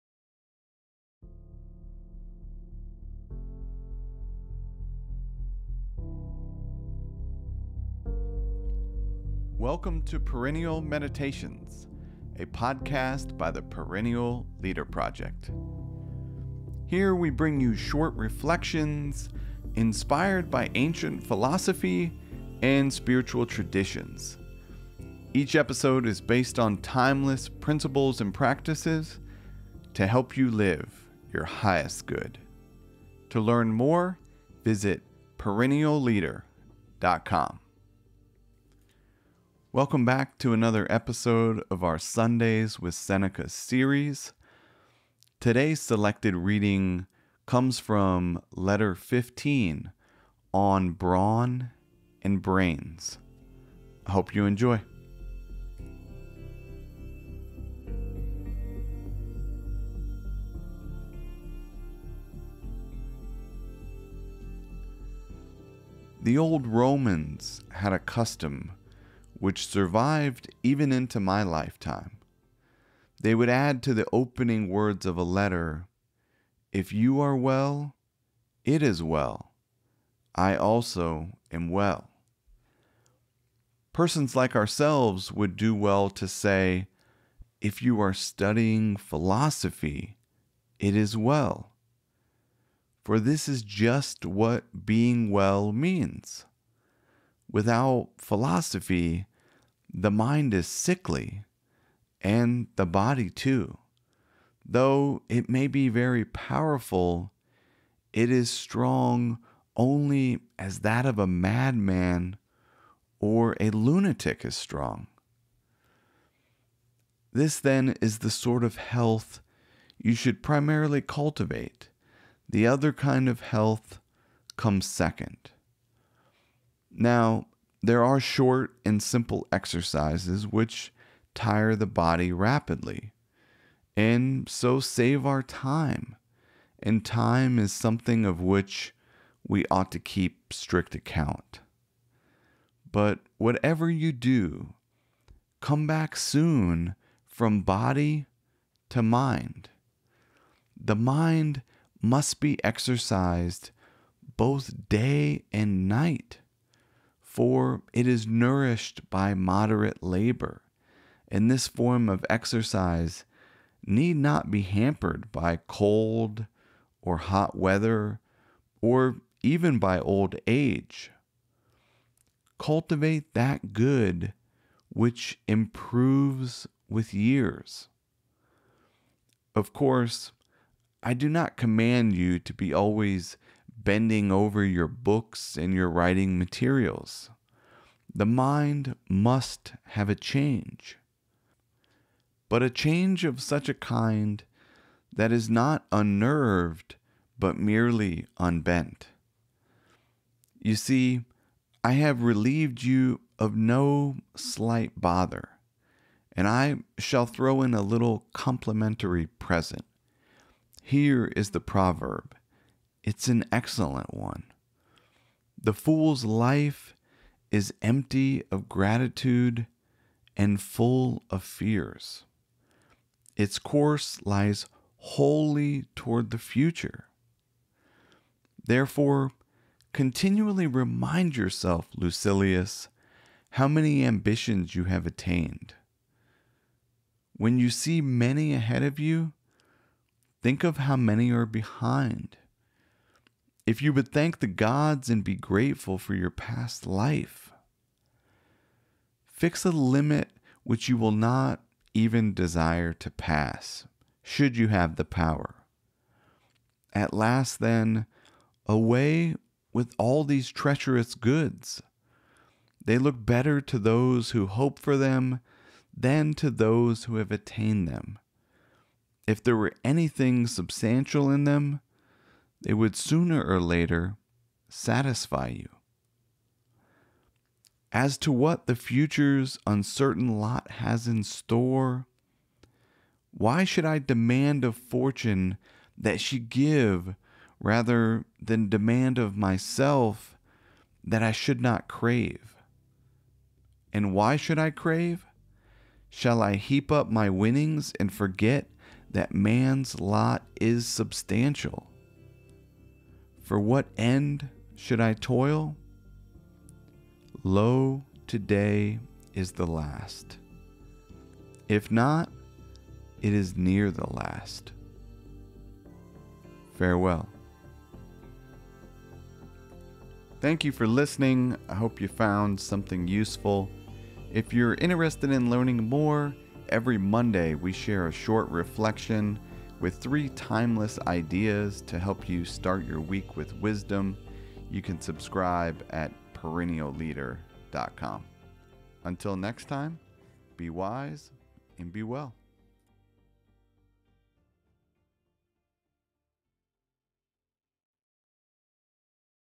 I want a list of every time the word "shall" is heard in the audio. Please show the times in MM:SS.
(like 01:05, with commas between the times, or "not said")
03:26, 04:56.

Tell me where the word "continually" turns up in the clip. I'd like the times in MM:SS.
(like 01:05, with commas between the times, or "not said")
03:49.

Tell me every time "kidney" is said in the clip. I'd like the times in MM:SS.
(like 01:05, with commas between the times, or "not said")
not said.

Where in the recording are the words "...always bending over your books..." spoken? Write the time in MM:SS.
03:02.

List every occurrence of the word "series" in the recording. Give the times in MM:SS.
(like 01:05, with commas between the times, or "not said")
00:43.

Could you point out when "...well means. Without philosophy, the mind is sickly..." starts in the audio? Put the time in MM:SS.
01:35.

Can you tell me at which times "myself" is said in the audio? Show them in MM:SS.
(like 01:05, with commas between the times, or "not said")
04:49.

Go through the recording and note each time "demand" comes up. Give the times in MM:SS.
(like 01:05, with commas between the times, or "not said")
04:43, 04:48.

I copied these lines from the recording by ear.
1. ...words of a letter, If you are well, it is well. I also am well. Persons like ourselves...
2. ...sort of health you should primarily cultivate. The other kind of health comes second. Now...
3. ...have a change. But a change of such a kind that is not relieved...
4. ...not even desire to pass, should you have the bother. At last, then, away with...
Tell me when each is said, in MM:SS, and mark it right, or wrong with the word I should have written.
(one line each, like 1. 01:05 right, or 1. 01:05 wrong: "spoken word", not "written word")
1. 01:14 right
2. 01:58 right
3. 03:09 wrong: "unnerved", not "relieved"
4. 04:11 wrong: "power", not "bother".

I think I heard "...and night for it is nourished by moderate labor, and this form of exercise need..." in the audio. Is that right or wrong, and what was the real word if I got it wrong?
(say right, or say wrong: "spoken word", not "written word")
right.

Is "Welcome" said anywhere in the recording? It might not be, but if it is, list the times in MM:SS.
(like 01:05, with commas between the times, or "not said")
00:09, 00:39.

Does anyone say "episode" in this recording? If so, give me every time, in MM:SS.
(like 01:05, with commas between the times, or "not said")
00:25, 00:40.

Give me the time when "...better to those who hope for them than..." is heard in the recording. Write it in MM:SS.
04:23.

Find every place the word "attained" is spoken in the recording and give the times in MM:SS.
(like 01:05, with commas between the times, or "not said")
03:55, 04:27.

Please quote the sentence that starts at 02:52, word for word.
Cultivate that good which improves with years.